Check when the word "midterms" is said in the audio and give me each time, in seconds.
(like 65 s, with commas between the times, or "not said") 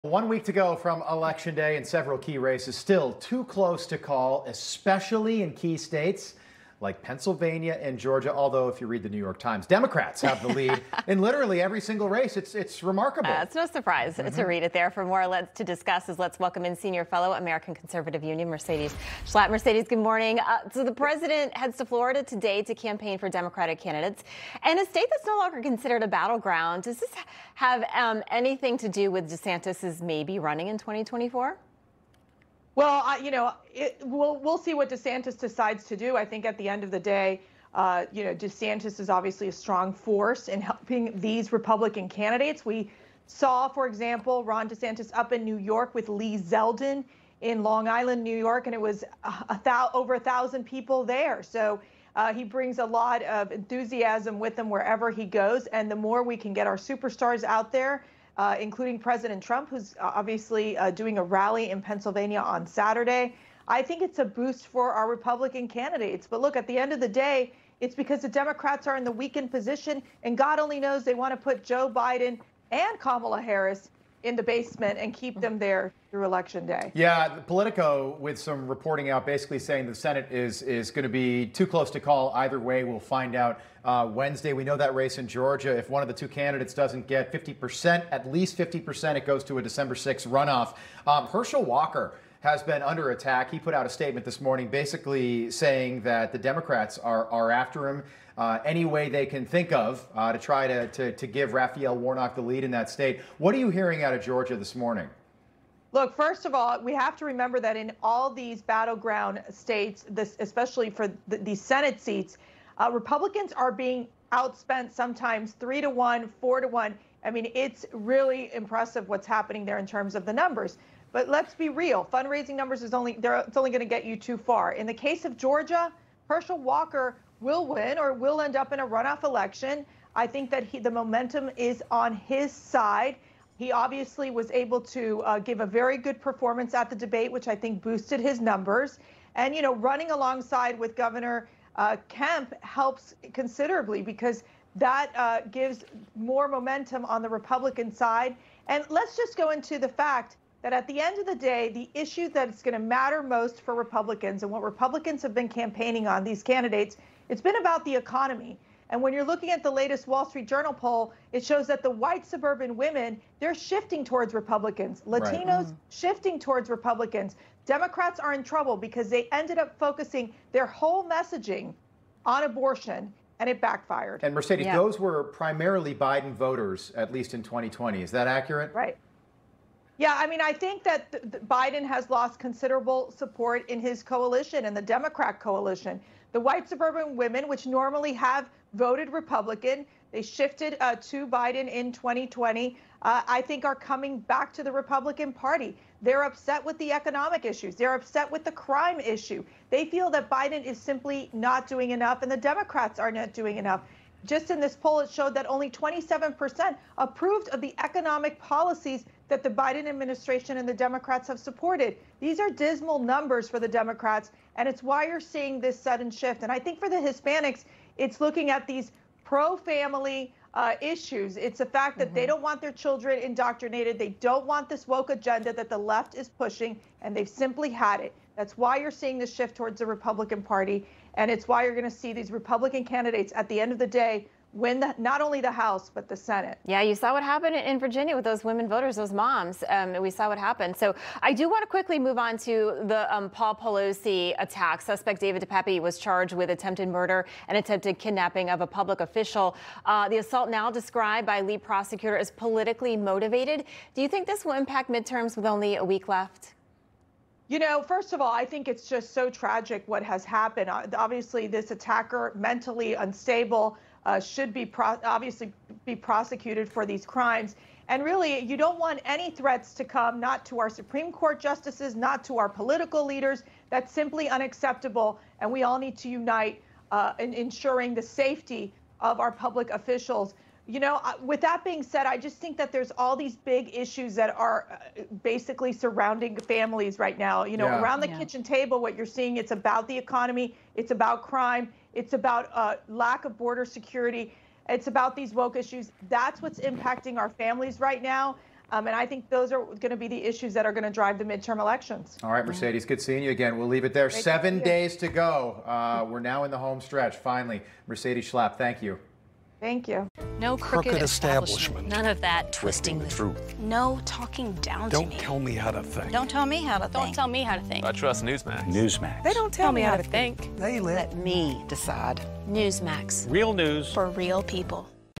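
254 s, 301 s.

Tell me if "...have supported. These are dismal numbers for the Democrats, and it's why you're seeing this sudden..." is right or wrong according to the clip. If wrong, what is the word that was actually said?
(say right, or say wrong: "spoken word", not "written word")
right.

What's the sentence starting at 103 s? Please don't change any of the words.
What are you hearing out of Georgia this morning?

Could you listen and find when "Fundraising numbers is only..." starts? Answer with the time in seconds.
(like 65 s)
122 s.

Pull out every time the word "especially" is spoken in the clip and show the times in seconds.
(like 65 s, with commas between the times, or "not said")
4 s, 110 s.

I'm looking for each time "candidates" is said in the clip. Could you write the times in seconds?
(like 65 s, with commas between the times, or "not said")
23 s, 42 s, 65 s, 86 s, 156 s, 232 s.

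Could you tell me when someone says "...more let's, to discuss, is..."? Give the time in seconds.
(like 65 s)
15 s.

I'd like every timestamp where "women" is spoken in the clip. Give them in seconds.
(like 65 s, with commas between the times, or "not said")
162 s, 187 s, 238 s.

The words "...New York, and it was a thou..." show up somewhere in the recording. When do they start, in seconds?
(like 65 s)
48 s.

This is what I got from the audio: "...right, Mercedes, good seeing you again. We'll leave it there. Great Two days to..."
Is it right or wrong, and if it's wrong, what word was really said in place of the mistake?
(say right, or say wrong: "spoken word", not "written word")
wrong: "Seven", not "Two".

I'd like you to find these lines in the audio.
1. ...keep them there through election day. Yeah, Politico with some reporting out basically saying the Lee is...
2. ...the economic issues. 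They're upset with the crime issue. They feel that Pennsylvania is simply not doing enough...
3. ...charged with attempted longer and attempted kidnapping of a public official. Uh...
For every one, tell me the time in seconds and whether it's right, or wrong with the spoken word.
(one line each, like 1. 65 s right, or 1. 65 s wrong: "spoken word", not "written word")
1. 75 s wrong: "Senate", not "Lee"
2. 196 s wrong: "Biden", not "Pennsylvania"
3. 245 s wrong: "murder", not "longer".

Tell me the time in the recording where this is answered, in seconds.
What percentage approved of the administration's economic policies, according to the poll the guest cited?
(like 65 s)
205 s.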